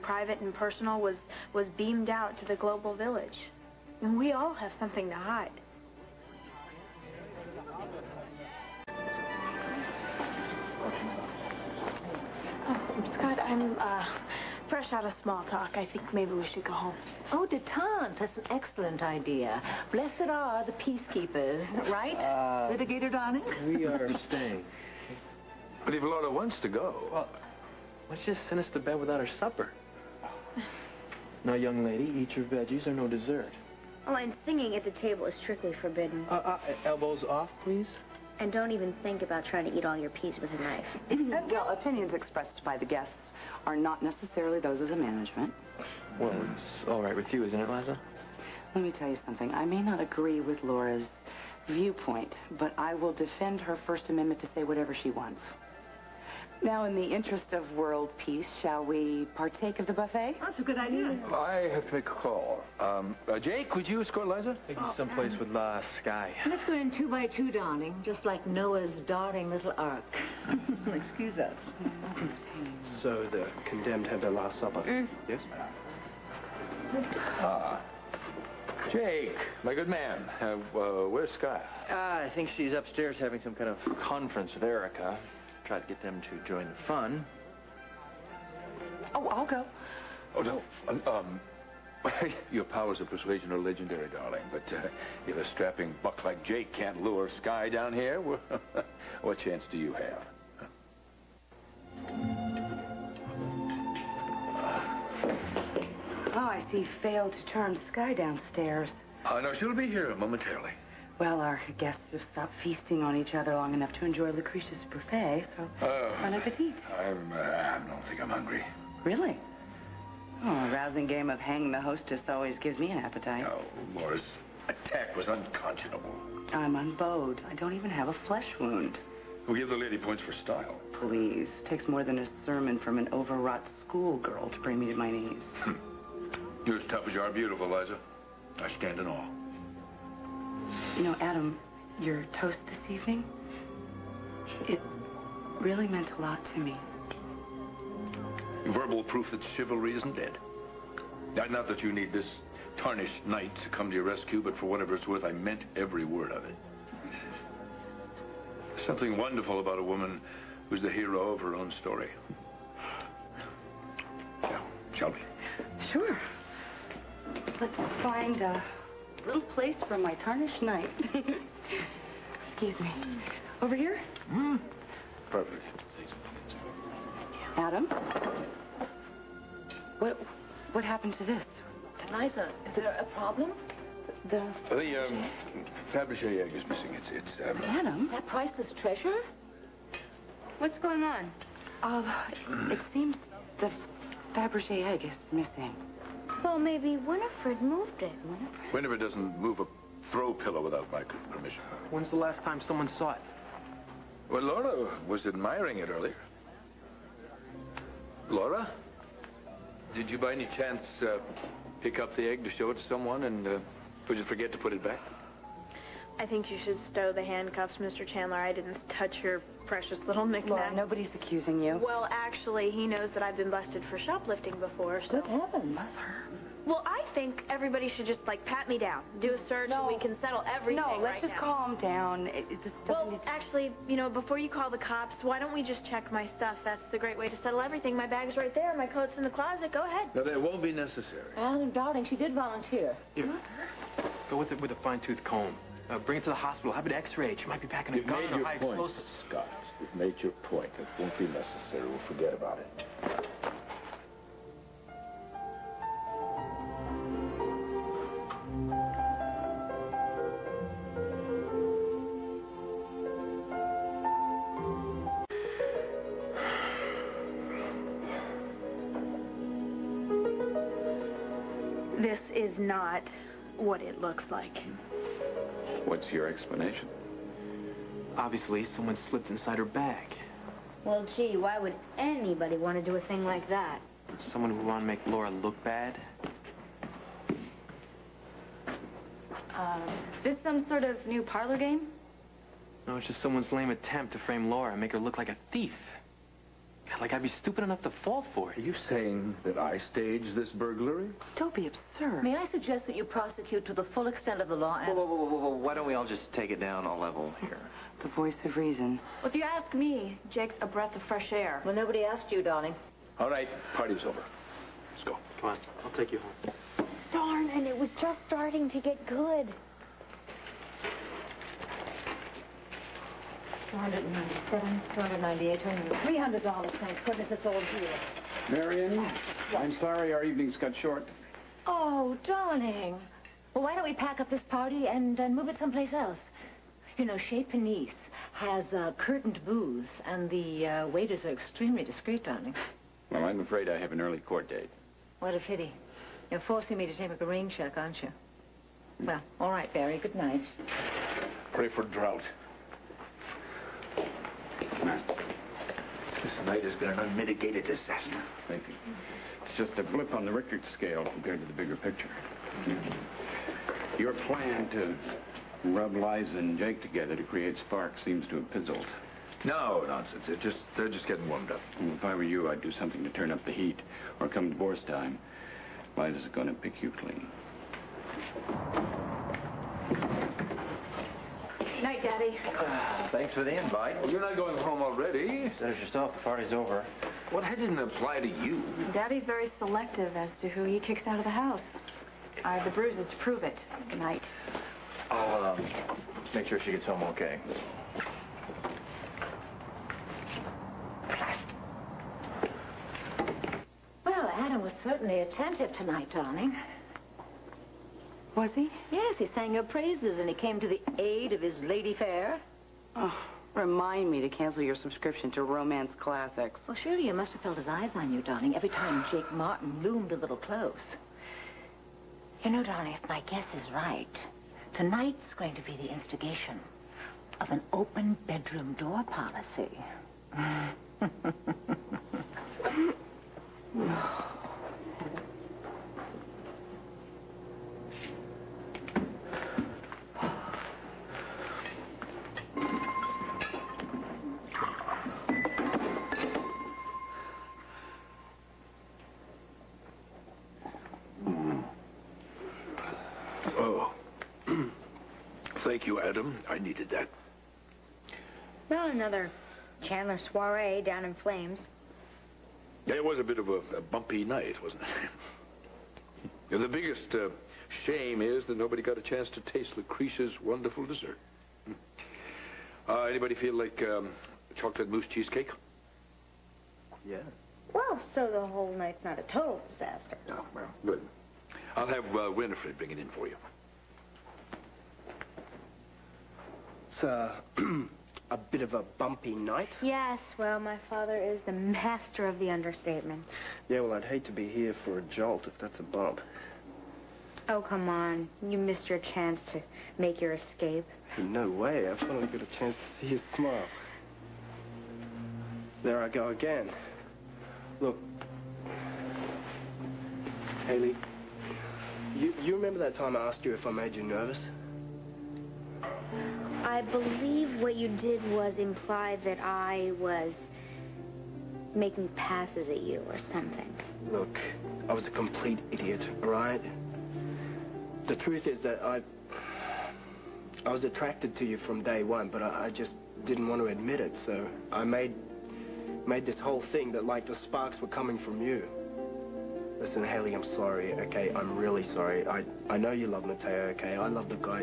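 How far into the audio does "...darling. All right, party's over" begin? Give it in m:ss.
5:12.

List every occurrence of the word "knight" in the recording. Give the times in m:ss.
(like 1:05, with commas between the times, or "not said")
2:33, 2:50.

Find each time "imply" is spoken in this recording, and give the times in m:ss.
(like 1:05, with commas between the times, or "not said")
8:38.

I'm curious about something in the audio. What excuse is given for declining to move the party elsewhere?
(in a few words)
An early court date.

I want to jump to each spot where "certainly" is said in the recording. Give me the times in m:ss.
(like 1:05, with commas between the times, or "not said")
6:44.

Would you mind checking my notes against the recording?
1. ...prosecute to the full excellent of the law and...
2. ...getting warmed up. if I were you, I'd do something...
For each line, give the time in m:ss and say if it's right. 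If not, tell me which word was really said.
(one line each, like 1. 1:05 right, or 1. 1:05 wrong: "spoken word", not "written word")
1. 5:03 wrong: "extent", not "excellent"
2. 6:11 right.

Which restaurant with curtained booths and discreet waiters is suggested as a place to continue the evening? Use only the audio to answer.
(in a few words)
Chez Panisse.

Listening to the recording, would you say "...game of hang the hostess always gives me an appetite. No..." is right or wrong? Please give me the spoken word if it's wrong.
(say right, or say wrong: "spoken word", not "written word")
right.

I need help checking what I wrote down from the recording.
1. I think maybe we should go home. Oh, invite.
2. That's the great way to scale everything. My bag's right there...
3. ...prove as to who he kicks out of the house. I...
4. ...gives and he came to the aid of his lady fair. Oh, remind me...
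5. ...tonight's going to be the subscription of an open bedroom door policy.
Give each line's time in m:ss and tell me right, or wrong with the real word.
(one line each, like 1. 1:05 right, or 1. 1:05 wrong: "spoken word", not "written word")
1. 0:15 wrong: "detente", not "invite"
2. 3:56 wrong: "settle", not "scale"
3. 6:29 wrong: "selective", not "prove"
4. 6:49 wrong: "praises", not "gives"
5. 7:04 wrong: "instigation", not "subscription".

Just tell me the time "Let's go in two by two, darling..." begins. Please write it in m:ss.
1:06.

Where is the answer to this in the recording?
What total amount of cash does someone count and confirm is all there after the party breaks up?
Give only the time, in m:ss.
5:26.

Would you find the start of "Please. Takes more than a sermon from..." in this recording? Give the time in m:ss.
2:10.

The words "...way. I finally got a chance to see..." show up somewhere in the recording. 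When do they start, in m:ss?
8:21.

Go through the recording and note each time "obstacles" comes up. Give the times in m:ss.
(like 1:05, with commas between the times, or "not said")
not said.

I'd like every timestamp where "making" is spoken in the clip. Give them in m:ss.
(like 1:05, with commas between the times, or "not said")
8:41.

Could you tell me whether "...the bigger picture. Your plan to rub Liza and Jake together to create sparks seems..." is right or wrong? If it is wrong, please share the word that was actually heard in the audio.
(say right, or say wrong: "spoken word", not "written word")
right.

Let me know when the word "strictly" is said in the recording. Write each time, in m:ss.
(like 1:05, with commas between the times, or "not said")
0:35.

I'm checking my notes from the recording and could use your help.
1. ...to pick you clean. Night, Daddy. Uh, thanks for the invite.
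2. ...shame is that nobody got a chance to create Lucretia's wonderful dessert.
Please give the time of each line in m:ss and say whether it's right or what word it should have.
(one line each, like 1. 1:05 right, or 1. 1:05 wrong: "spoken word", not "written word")
1. 6:16 right
2. 7:47 wrong: "taste", not "create".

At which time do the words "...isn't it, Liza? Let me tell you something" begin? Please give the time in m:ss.
0:47.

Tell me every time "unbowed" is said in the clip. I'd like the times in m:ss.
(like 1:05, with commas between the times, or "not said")
2:06.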